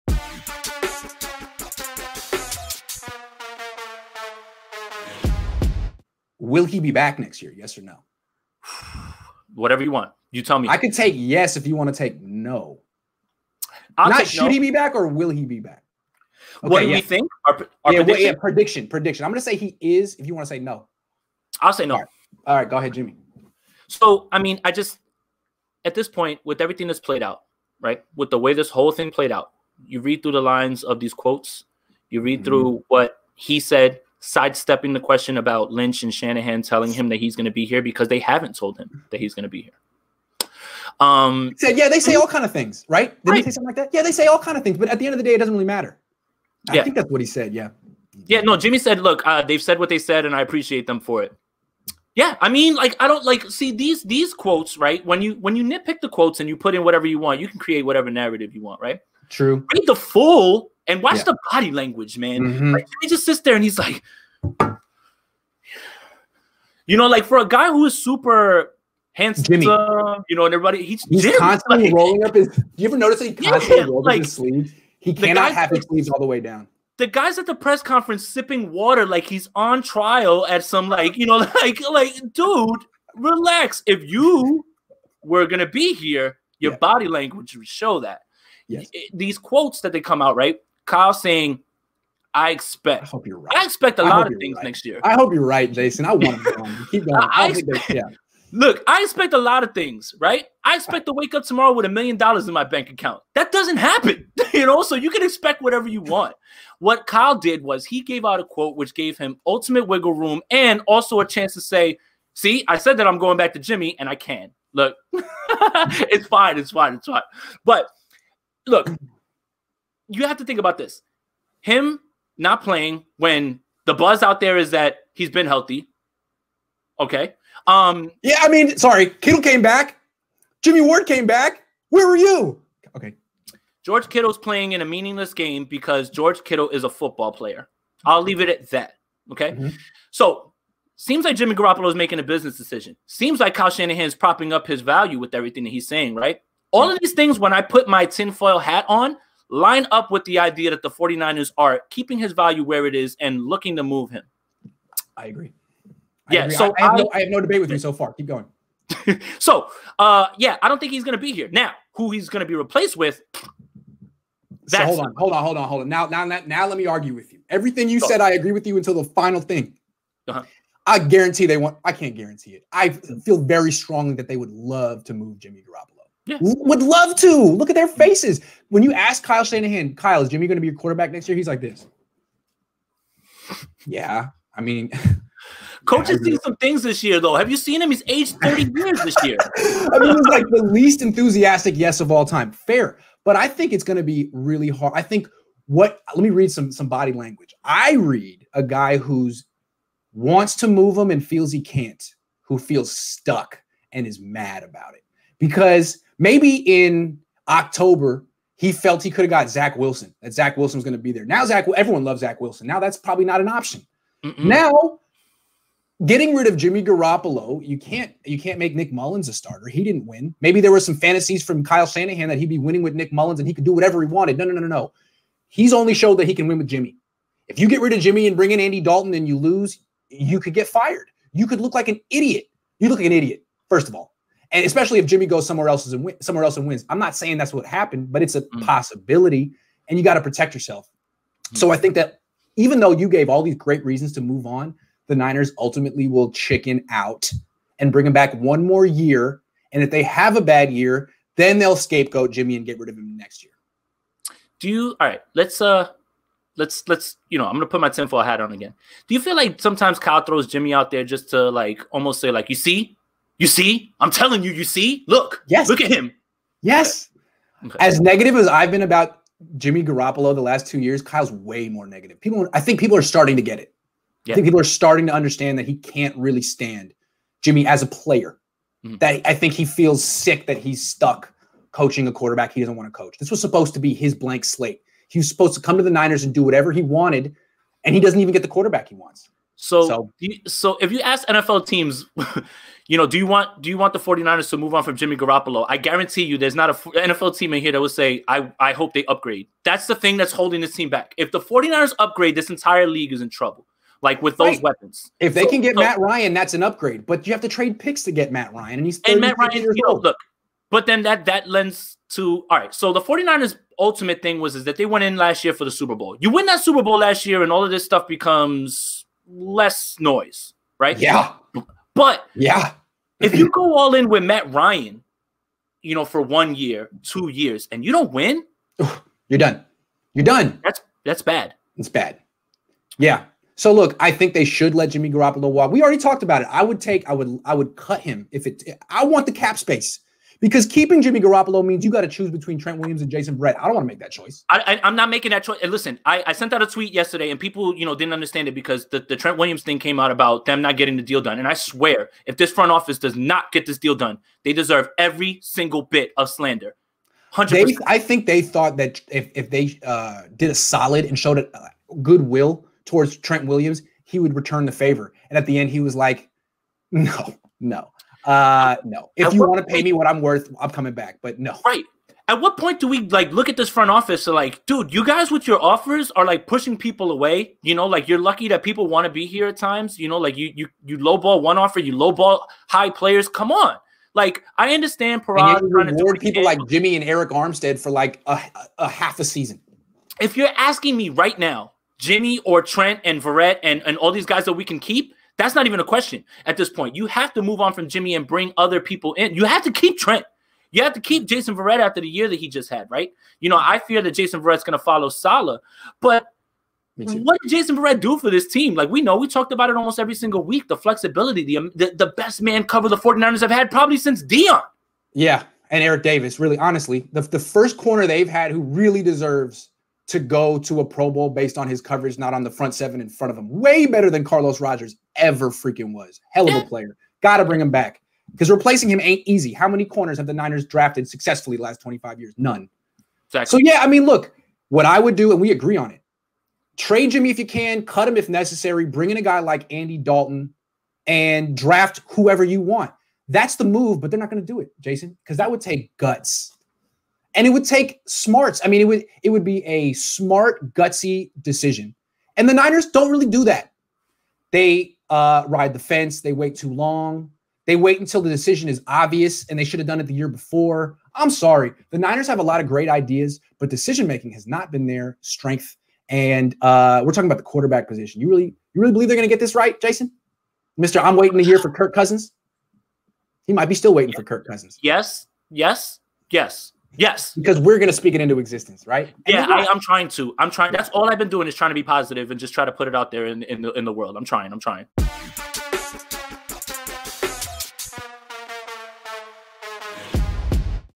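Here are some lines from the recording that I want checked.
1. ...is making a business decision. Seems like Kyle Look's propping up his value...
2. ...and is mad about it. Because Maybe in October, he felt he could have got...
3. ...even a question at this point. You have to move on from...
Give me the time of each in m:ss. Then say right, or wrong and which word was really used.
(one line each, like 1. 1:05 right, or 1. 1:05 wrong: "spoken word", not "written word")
1. 2:21 wrong: "Shanahan", not "Look"
2. 3:23 right
3. 6:35 right.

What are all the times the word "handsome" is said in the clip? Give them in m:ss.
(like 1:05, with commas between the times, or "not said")
1:09.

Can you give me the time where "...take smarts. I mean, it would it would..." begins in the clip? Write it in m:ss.
7:27.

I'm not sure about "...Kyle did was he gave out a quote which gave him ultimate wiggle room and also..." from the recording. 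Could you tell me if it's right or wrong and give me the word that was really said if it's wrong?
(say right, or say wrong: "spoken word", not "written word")
right.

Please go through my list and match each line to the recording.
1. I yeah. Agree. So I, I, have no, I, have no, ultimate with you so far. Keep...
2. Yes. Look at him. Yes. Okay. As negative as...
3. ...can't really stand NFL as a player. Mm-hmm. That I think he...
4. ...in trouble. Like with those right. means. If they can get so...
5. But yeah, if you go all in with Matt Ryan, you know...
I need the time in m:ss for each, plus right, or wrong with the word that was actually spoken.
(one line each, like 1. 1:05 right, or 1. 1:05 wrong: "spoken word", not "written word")
1. 2:36 wrong: "debate", not "ultimate"
2. 4:25 right
3. 4:35 wrong: "Jimmy", not "NFL"
4. 5:03 wrong: "weapons", not "means"
5. 5:21 right.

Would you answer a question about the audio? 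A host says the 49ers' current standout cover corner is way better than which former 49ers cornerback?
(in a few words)
Carlos Rogers.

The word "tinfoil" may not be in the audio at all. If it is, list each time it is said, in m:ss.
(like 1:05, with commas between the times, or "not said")
2:28, 4:17.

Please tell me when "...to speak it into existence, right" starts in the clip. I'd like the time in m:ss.
7:57.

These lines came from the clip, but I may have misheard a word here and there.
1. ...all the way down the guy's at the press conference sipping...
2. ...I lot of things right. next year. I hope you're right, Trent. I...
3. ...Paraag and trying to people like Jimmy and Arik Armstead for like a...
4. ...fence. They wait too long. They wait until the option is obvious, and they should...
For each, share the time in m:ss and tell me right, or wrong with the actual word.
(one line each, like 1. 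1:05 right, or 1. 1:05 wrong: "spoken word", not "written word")
1. 1:16 right
2. 1:34 wrong: "Jason", not "Trent"
3. 6:25 right
4. 7:35 wrong: "decision", not "option".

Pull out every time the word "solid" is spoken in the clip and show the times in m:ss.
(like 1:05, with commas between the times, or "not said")
6:00.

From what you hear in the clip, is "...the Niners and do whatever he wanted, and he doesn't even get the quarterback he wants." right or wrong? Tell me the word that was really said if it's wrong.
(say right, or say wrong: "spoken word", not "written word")
right.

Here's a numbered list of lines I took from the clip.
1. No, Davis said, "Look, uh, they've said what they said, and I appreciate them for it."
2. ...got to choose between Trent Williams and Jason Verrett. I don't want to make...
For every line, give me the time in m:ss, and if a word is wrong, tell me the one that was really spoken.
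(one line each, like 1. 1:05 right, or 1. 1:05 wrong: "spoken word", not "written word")
1. 0:48 wrong: "Jimmy", not "Davis"
2. 5:41 right.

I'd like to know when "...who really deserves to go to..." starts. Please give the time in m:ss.
6:58.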